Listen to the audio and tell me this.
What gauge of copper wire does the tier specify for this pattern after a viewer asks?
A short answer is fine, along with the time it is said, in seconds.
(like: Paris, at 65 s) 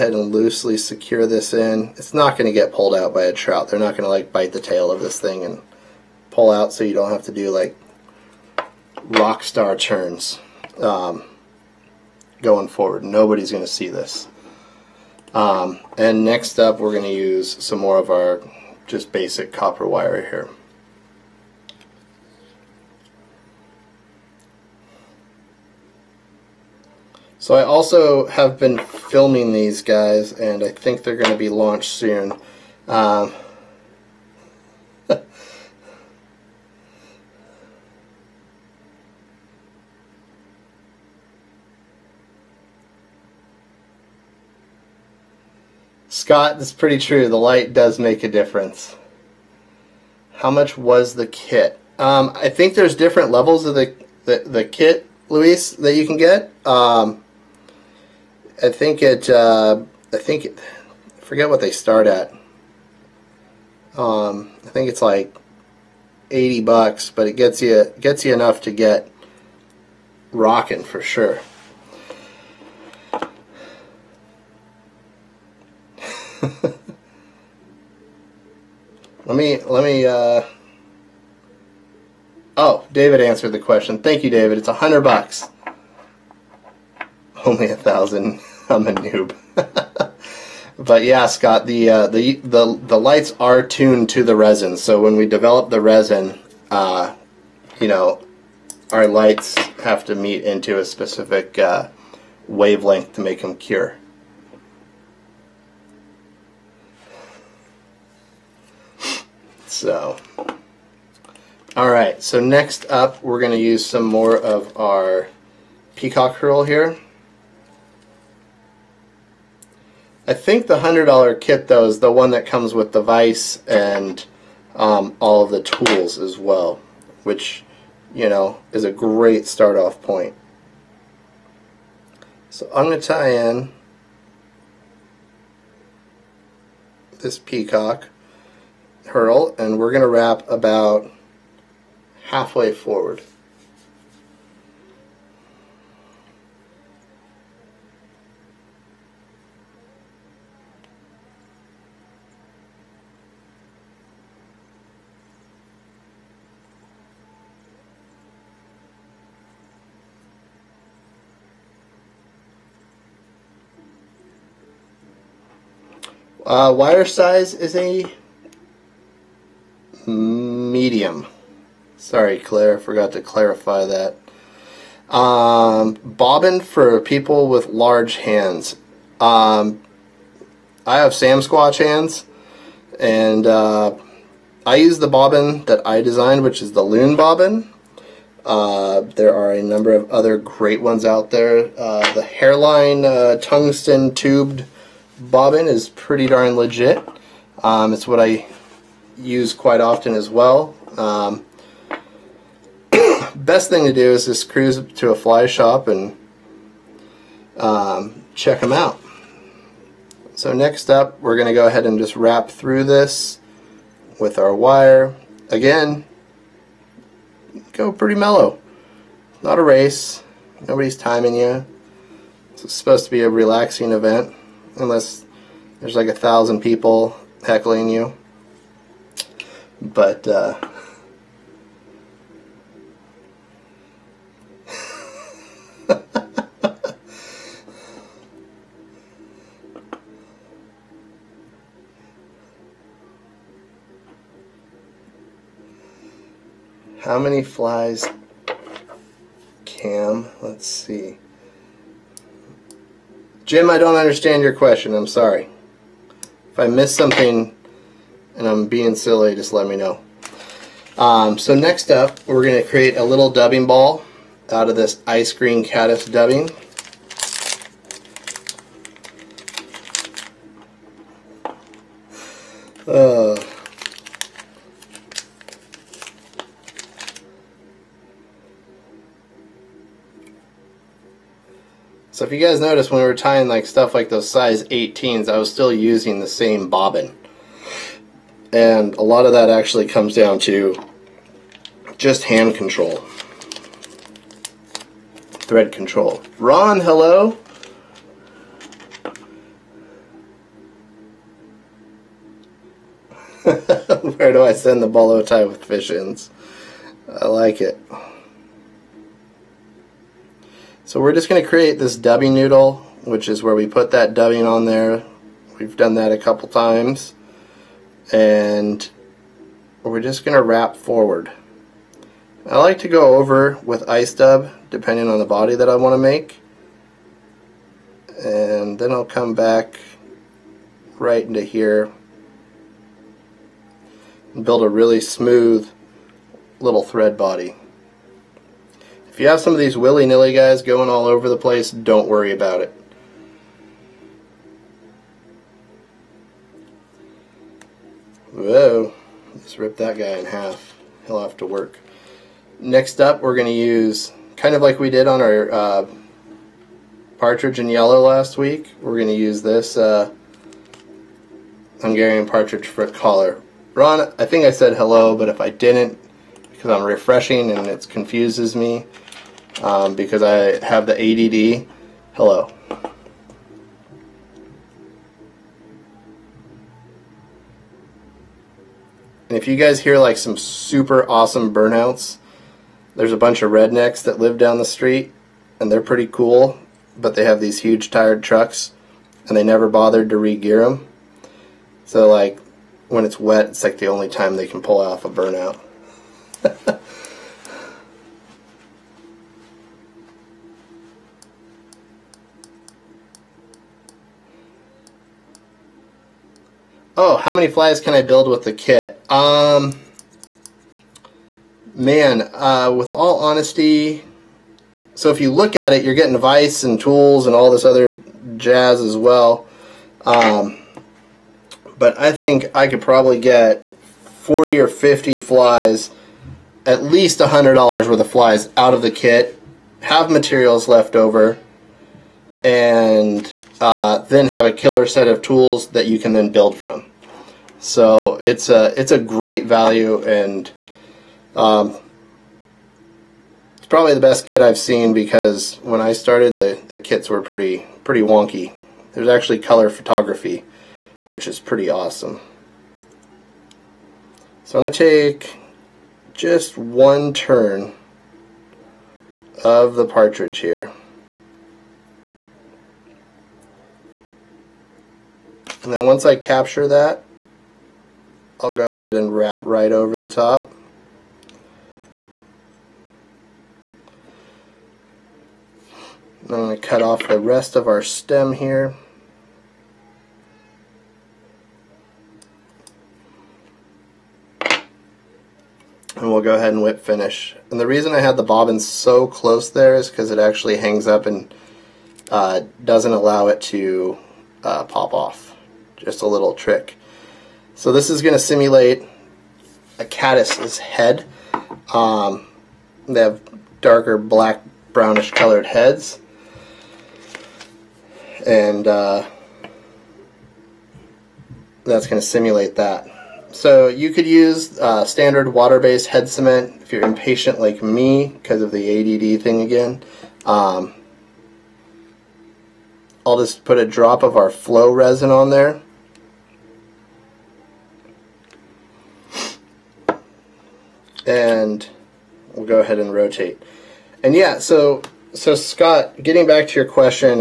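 Medium, at 167 s.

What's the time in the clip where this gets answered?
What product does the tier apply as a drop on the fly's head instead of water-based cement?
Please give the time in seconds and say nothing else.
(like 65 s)
524 s.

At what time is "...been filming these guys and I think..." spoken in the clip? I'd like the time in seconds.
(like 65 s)
28 s.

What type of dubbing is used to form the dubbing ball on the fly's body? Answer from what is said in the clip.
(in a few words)
Ice cream caddis dubbing.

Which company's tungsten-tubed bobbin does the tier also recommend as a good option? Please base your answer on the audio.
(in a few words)
Hareline.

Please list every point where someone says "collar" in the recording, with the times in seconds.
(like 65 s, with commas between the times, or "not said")
362 s.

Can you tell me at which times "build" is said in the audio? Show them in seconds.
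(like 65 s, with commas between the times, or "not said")
334 s, 408 s, 436 s.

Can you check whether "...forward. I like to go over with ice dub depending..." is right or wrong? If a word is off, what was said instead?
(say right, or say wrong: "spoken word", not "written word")
right.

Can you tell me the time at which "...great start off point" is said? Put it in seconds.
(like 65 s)
128 s.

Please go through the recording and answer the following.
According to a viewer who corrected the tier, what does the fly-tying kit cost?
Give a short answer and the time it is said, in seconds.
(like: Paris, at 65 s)
$100, at 84 s.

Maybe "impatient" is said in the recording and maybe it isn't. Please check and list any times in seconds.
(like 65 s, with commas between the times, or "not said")
516 s.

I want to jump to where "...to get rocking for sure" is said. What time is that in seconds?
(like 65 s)
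68 s.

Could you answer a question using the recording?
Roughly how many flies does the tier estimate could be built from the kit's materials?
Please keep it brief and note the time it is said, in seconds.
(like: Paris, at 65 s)
40 or 50, at 424 s.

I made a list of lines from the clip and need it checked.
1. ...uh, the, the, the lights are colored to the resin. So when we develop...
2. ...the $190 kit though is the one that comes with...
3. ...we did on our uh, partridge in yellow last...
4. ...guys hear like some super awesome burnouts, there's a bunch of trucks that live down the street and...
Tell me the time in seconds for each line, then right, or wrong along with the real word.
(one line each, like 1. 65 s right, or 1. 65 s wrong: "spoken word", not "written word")
1. 91 s wrong: "tuned", not "colored"
2. 120 s wrong: "100", not "190"
3. 354 s right
4. 379 s wrong: "rednecks", not "trucks".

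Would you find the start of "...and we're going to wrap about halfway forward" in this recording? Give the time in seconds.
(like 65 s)
139 s.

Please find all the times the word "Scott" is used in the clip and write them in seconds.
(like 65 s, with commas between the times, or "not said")
46 s, 91 s, 535 s.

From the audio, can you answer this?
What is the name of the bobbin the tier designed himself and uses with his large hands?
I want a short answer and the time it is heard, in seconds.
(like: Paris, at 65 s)
Loon bobbin, at 186 s.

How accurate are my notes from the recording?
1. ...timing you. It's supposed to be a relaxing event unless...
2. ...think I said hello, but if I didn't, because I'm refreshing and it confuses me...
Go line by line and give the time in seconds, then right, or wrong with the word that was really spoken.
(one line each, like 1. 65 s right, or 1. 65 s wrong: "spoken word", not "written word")
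1. 220 s right
2. 364 s right.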